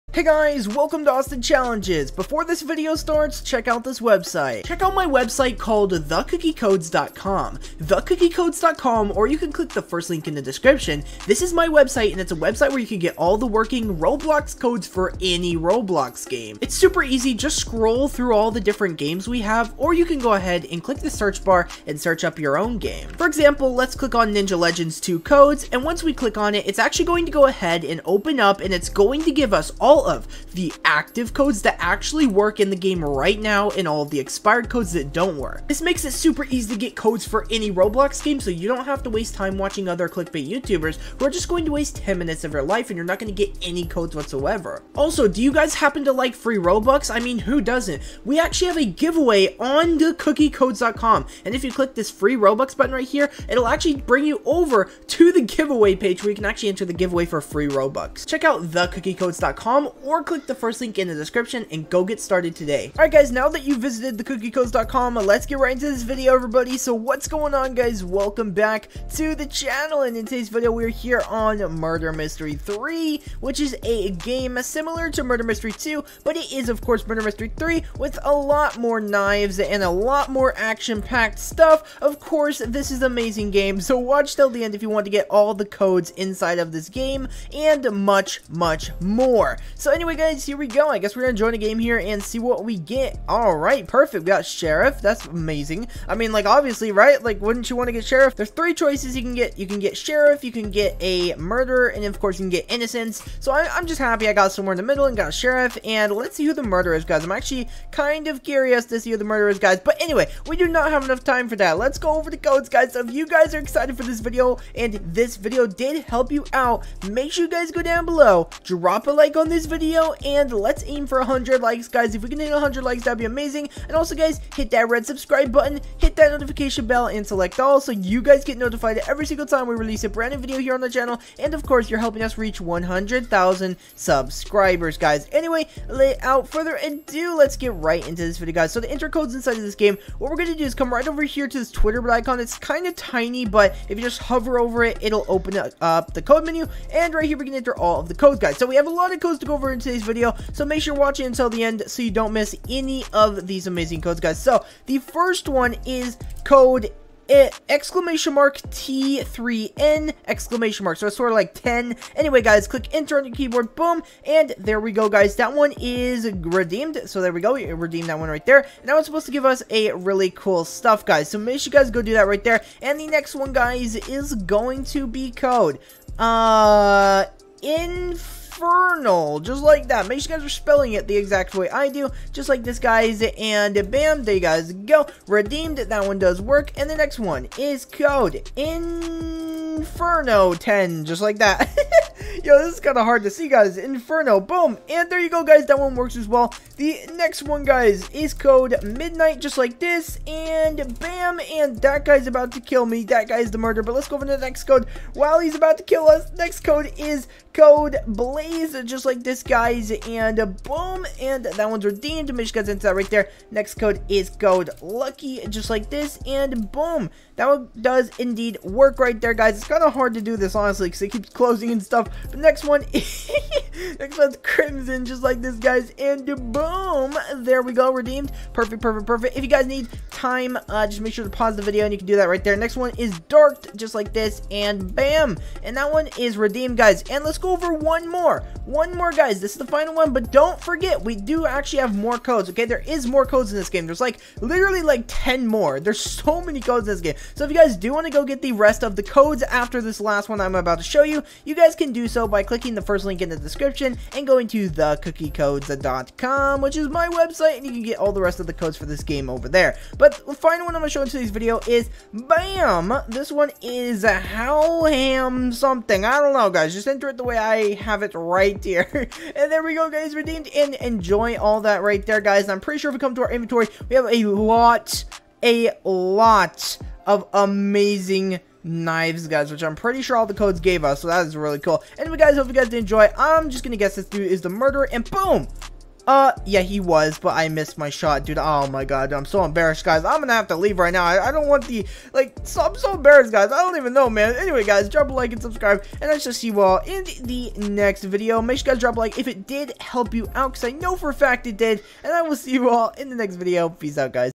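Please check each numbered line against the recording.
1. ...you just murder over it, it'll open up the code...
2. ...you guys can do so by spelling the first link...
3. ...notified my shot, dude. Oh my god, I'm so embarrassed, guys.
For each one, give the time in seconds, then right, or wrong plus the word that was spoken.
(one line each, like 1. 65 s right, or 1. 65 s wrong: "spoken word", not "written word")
1. 143 s wrong: "hover", not "murder"
2. 251 s wrong: "clicking", not "spelling"
3. 287 s wrong: "missed", not "notified".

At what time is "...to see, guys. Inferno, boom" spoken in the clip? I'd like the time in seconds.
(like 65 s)
193 s.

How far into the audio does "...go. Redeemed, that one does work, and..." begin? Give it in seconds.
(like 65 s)
184 s.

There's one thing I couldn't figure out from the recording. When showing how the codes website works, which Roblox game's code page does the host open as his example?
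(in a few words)
Ninja Legends 2.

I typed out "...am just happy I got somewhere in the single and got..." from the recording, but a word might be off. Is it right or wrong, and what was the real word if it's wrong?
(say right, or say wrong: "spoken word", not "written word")
wrong: "middle", not "single".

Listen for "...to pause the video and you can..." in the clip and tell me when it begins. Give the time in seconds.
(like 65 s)
231 s.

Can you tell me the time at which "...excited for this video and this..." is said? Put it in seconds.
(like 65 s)
113 s.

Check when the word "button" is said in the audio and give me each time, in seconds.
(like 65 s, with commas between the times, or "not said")
52 s, 125 s.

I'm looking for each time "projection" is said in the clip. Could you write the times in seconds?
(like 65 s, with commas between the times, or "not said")
not said.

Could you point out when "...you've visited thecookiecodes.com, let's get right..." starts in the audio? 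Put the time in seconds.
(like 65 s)
63 s.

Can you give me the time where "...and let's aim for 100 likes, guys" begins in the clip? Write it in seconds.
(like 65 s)
120 s.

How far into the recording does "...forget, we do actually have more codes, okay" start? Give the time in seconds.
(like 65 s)
240 s.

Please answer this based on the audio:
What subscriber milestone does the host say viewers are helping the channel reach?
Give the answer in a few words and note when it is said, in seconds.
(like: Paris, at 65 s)
100,000, at 132 s.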